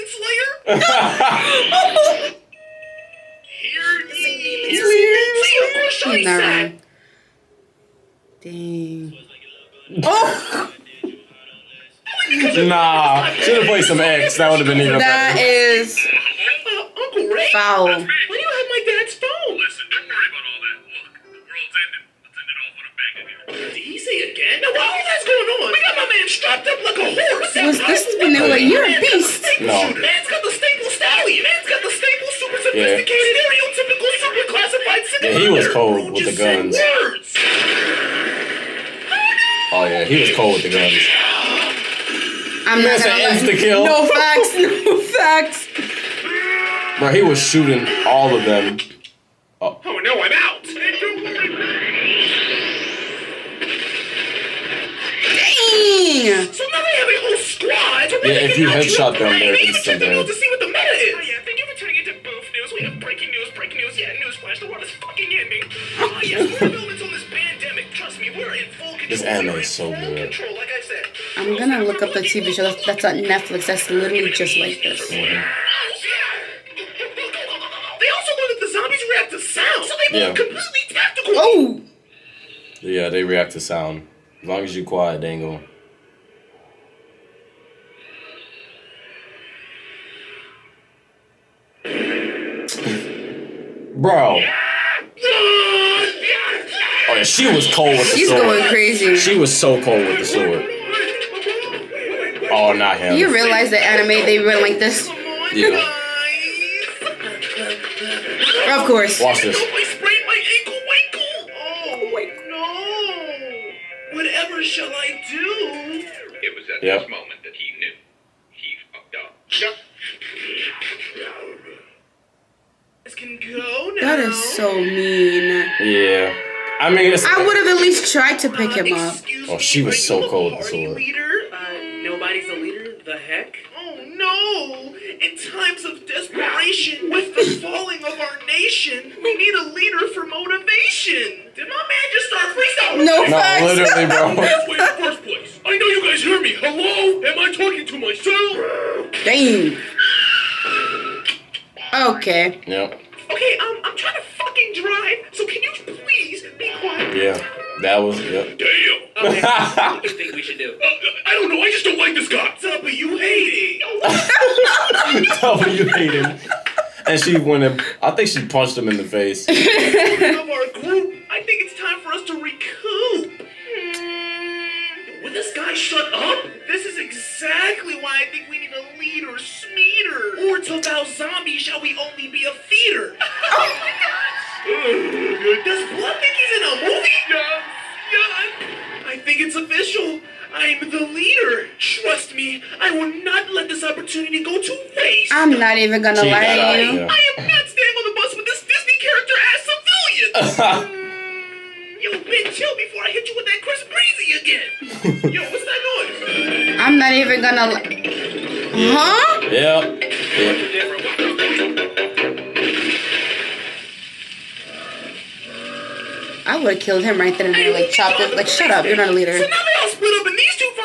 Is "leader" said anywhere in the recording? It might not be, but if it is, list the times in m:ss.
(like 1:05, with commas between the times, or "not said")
2:19, 3:39.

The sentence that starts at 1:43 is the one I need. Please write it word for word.
You realize that anime they went like this?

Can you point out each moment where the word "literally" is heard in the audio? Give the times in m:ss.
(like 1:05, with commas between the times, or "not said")
1:13, 2:23.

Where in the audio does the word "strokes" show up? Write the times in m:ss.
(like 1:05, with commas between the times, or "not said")
not said.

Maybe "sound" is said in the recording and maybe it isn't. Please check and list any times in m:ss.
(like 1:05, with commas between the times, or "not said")
1:19, 1:23.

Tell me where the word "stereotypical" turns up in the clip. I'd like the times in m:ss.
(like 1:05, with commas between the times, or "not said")
0:33.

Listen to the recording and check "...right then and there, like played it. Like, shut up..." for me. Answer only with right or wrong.
wrong.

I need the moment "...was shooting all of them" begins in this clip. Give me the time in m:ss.
0:47.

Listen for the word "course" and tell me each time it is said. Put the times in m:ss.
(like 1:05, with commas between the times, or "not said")
0:05, 1:48.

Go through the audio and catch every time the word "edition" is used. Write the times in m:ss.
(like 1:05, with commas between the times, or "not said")
not said.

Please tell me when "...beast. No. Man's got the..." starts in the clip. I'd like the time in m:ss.
0:29.